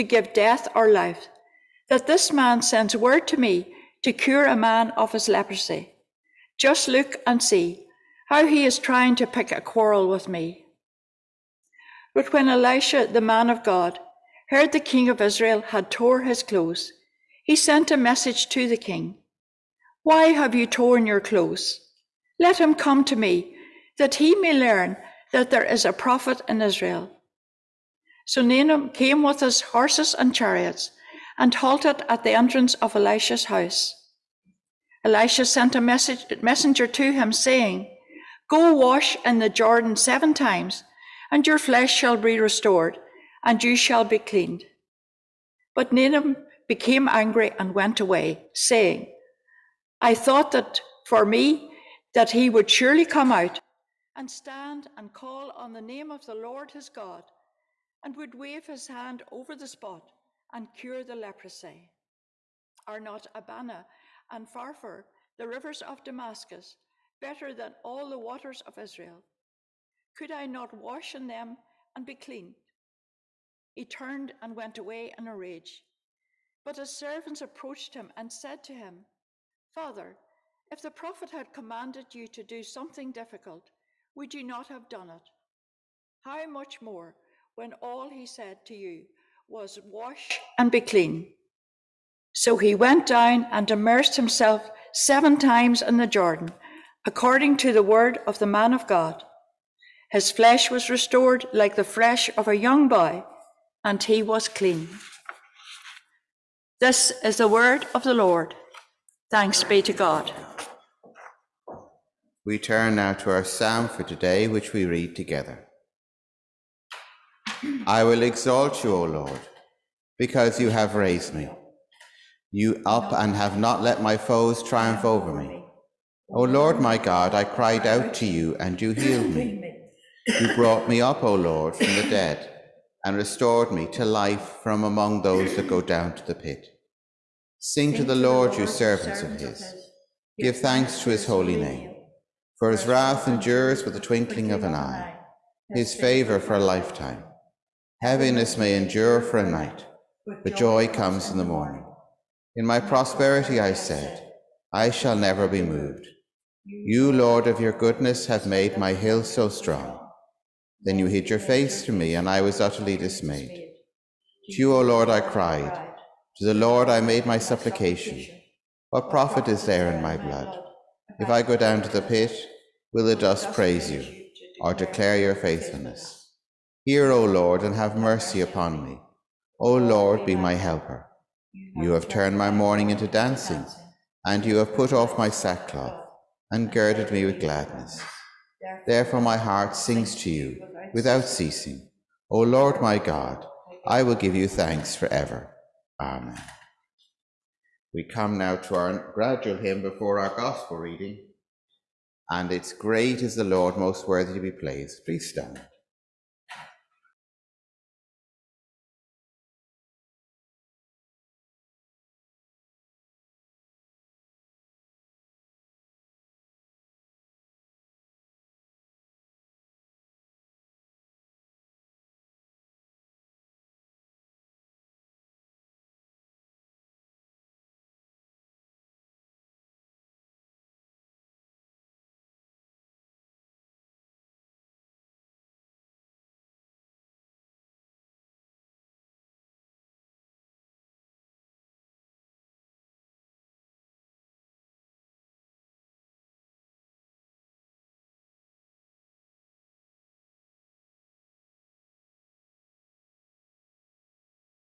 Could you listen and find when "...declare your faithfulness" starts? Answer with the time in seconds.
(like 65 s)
174 s.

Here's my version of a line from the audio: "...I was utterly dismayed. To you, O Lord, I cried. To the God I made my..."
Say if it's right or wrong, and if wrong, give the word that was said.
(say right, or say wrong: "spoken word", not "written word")
wrong: "Lord", not "God".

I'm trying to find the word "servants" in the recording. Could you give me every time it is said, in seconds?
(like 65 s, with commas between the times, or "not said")
76 s, 138 s.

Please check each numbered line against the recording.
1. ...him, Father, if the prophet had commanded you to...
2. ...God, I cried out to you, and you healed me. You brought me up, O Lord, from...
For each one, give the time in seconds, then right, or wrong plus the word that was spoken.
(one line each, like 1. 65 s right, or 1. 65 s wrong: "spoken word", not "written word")
1. 78 s right
2. 126 s right.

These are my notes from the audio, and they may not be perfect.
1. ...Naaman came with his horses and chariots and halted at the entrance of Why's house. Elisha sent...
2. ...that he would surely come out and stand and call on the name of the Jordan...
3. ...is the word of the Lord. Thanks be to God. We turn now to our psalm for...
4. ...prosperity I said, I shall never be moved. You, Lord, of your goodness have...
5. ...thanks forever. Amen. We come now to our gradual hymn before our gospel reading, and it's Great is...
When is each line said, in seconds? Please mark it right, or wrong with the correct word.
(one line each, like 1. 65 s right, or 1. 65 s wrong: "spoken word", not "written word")
1. 28 s wrong: "Elisha", not "Why"
2. 52 s wrong: "Lord", not "Jordan"
3. 107 s right
4. 152 s right
5. 194 s right.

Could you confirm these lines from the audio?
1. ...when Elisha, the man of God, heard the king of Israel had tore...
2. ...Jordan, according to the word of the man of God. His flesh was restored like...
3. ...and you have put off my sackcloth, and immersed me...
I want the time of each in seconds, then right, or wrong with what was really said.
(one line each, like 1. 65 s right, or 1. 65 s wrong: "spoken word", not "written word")
1. 12 s right
2. 96 s right
3. 184 s wrong: "girded", not "immersed".